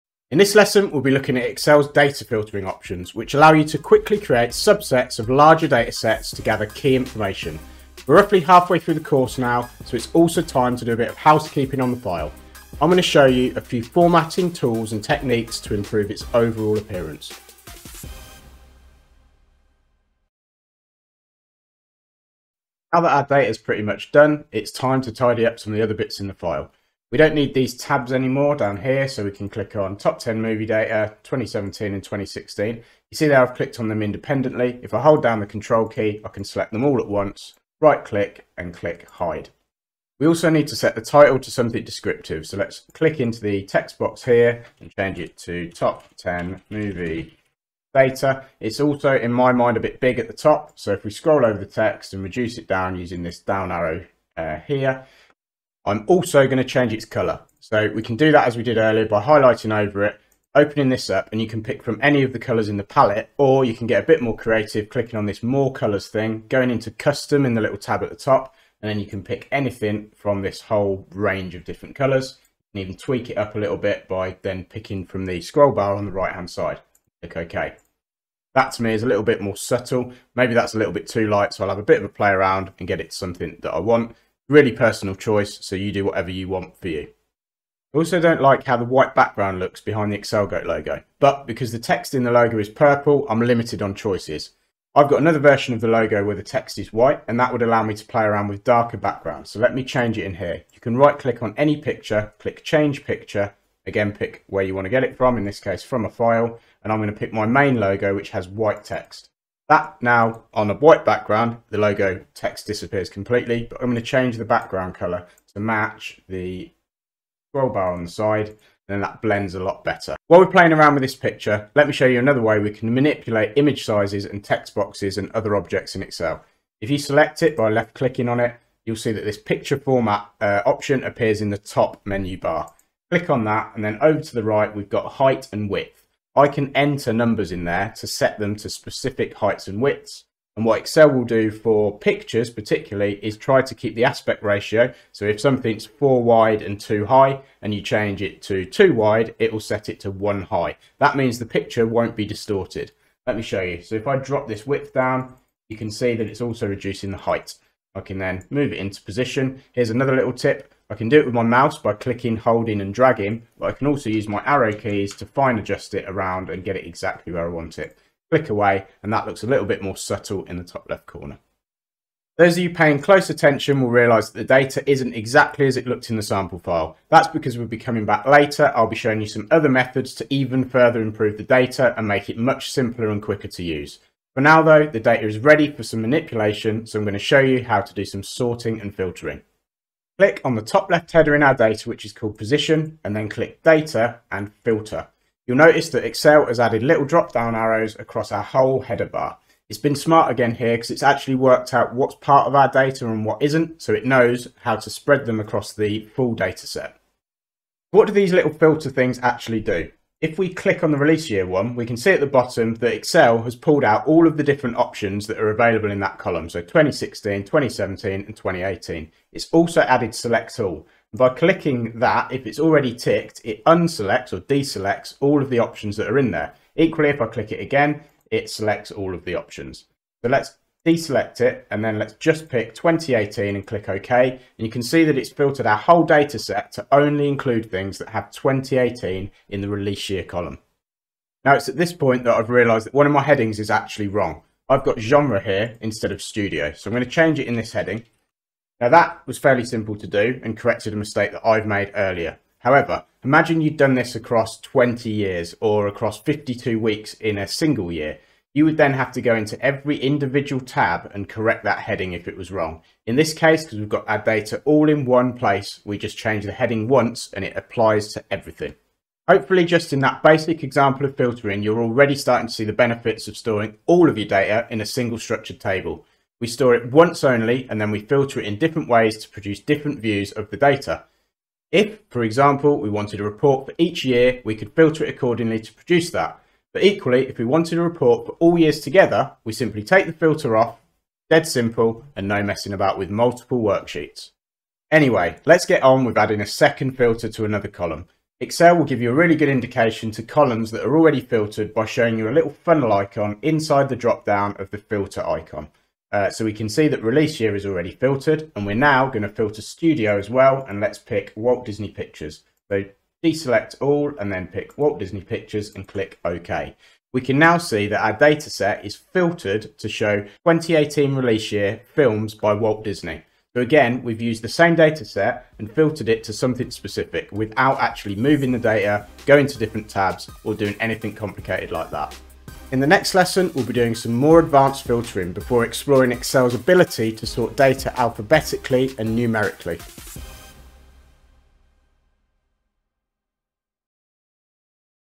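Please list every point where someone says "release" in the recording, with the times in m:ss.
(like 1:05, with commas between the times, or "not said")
3:30, 3:59, 5:07, 5:21.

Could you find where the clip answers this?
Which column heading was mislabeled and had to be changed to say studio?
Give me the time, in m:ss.
4:04.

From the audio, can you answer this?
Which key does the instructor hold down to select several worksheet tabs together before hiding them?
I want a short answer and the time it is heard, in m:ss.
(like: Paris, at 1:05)
Control, at 0:35.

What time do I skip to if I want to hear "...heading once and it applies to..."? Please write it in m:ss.
4:26.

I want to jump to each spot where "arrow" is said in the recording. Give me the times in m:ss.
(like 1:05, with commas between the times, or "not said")
0:53, 2:44, 3:17.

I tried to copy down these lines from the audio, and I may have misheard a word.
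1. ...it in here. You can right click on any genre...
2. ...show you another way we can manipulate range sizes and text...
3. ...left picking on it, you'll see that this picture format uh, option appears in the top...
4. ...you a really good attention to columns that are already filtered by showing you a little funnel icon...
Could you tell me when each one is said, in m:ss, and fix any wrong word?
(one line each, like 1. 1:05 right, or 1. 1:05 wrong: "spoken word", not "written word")
1. 1:40 wrong: "picture", not "genre"
2. 2:01 wrong: "image", not "range"
3. 2:07 wrong: "clicking", not "picking"
4. 4:59 wrong: "indication", not "attention".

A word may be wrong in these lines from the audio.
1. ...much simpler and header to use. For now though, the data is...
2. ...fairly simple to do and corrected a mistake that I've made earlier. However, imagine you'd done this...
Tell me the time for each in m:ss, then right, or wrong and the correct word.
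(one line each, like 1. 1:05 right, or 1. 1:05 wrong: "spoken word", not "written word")
1. 3:02 wrong: "quicker", not "header"
2. 4:09 right.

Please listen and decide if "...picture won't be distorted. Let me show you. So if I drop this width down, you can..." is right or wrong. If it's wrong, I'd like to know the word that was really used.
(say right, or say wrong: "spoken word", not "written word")
right.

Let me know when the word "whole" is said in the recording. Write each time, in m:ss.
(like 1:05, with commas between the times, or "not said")
1:10, 3:18, 3:55.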